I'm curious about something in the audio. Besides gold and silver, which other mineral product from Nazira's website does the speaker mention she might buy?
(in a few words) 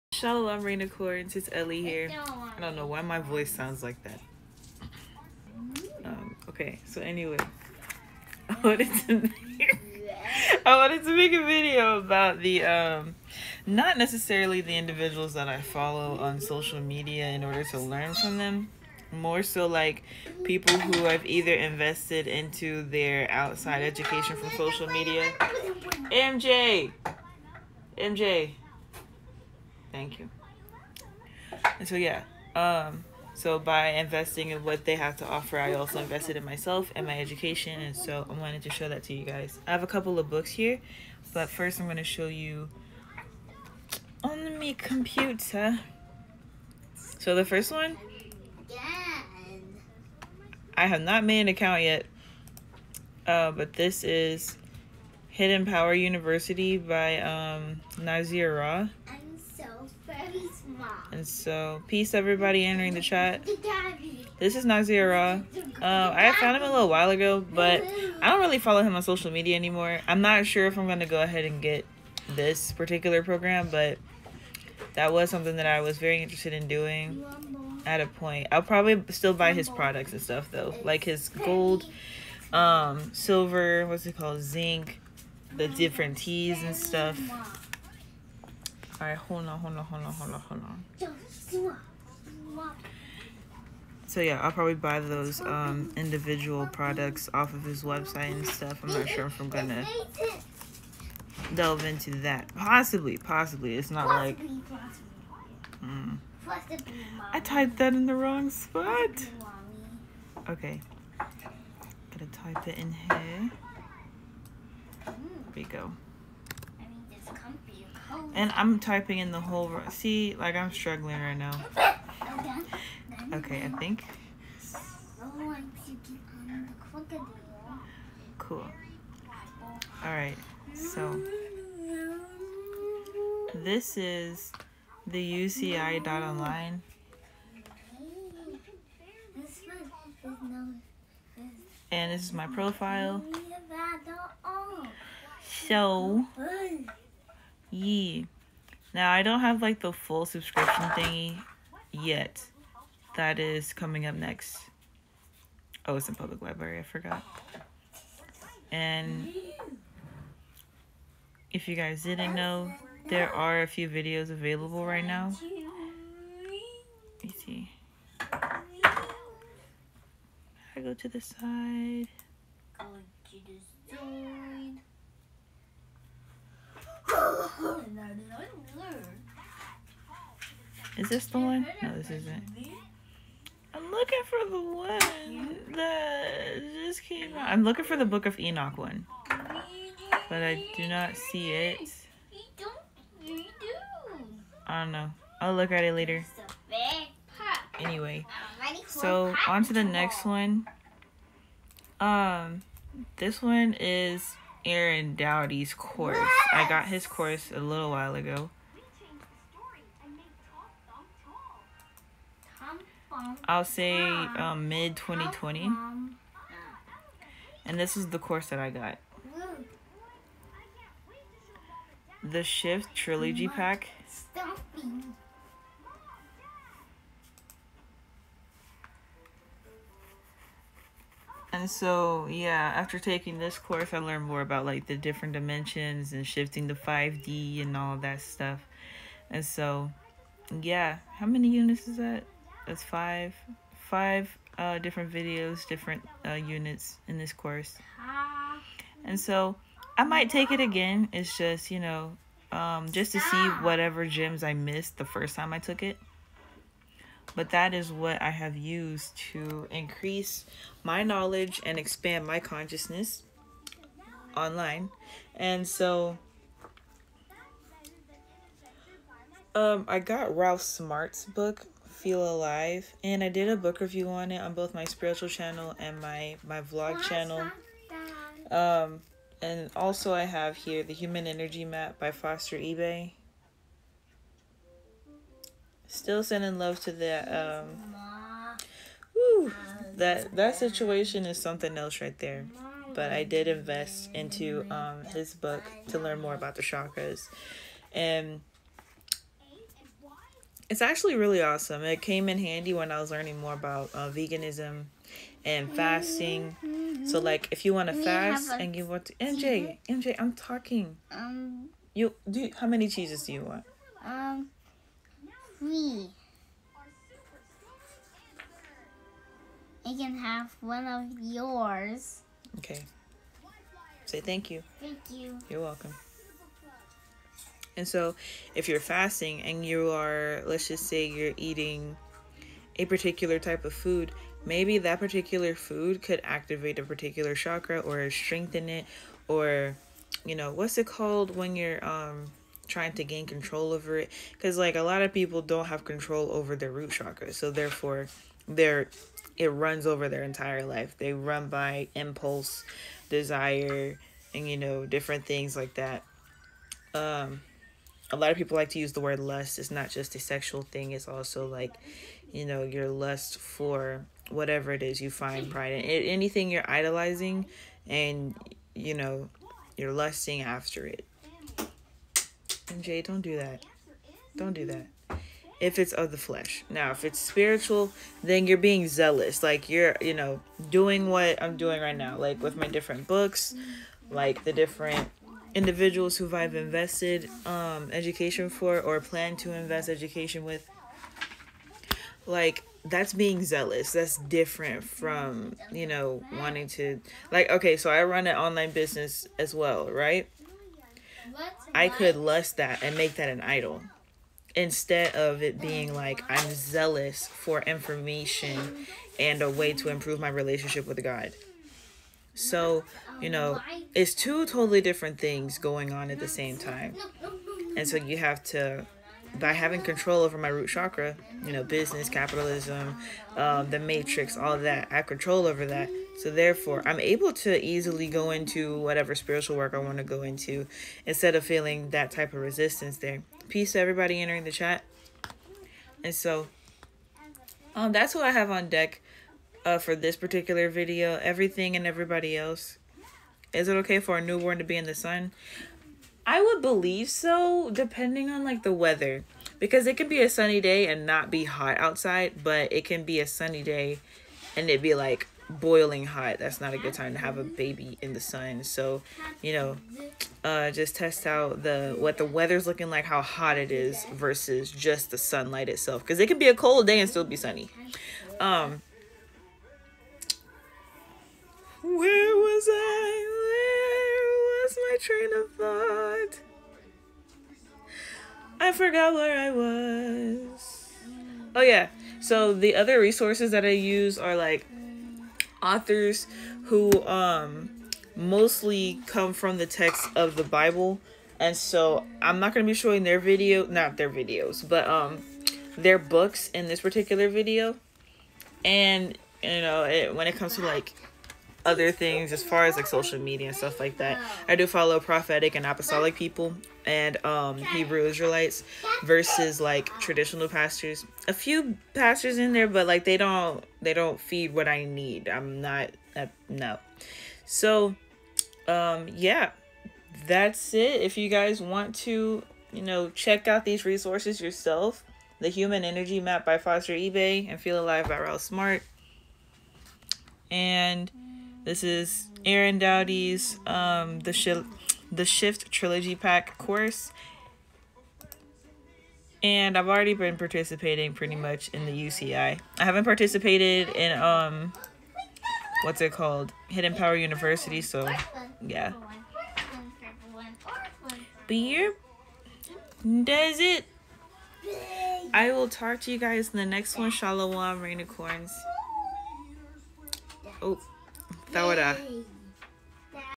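zinc.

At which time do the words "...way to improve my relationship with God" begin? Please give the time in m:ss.
6:49.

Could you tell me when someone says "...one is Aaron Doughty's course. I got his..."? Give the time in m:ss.
3:23.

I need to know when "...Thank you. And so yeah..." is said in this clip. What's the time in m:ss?
0:29.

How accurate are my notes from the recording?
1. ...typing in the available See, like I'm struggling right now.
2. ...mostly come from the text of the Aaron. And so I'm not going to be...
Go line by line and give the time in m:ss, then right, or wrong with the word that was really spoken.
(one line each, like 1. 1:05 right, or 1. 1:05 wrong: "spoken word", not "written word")
1. 1:58 wrong: "whole", not "available"
2. 8:08 wrong: "Bible", not "Aaron".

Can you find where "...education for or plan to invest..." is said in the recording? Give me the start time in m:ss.
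6:27.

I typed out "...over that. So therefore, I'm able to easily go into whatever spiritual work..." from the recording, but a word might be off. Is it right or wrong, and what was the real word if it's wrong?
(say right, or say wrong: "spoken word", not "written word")
right.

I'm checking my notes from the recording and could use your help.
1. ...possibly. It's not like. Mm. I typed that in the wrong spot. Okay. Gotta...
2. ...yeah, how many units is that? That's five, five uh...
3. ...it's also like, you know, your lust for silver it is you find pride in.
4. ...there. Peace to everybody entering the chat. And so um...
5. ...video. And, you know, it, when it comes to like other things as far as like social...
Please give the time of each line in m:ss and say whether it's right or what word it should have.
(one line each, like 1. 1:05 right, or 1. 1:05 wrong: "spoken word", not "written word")
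1. 1:43 right
2. 4:00 right
3. 6:00 wrong: "whatever", not "silver"
4. 7:12 right
5. 8:17 right.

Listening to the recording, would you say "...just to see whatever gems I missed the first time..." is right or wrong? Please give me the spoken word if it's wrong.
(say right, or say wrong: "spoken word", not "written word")
right.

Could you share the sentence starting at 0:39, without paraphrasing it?
I have a couple of books here, but first I'm going to show you on my computer.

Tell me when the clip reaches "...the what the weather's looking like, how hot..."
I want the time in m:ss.
7:41.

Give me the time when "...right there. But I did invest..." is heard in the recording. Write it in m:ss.
4:52.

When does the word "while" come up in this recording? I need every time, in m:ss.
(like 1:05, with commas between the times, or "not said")
1:06, 3:27.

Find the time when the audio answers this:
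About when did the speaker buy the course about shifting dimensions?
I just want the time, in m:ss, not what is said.
3:34.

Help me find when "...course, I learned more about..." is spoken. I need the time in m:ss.
3:53.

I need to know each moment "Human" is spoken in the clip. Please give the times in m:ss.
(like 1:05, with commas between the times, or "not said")
4:40, 8:45.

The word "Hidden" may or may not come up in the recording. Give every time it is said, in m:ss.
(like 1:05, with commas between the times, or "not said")
0:55, 9:06.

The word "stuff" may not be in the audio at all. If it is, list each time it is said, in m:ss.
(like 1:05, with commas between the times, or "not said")
1:20, 1:26, 1:38, 3:58, 8:23.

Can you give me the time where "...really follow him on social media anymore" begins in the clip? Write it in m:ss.
1:08.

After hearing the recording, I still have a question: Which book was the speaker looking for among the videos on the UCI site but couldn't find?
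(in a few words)
Book of Enoch.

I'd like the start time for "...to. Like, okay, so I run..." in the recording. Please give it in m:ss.
6:36.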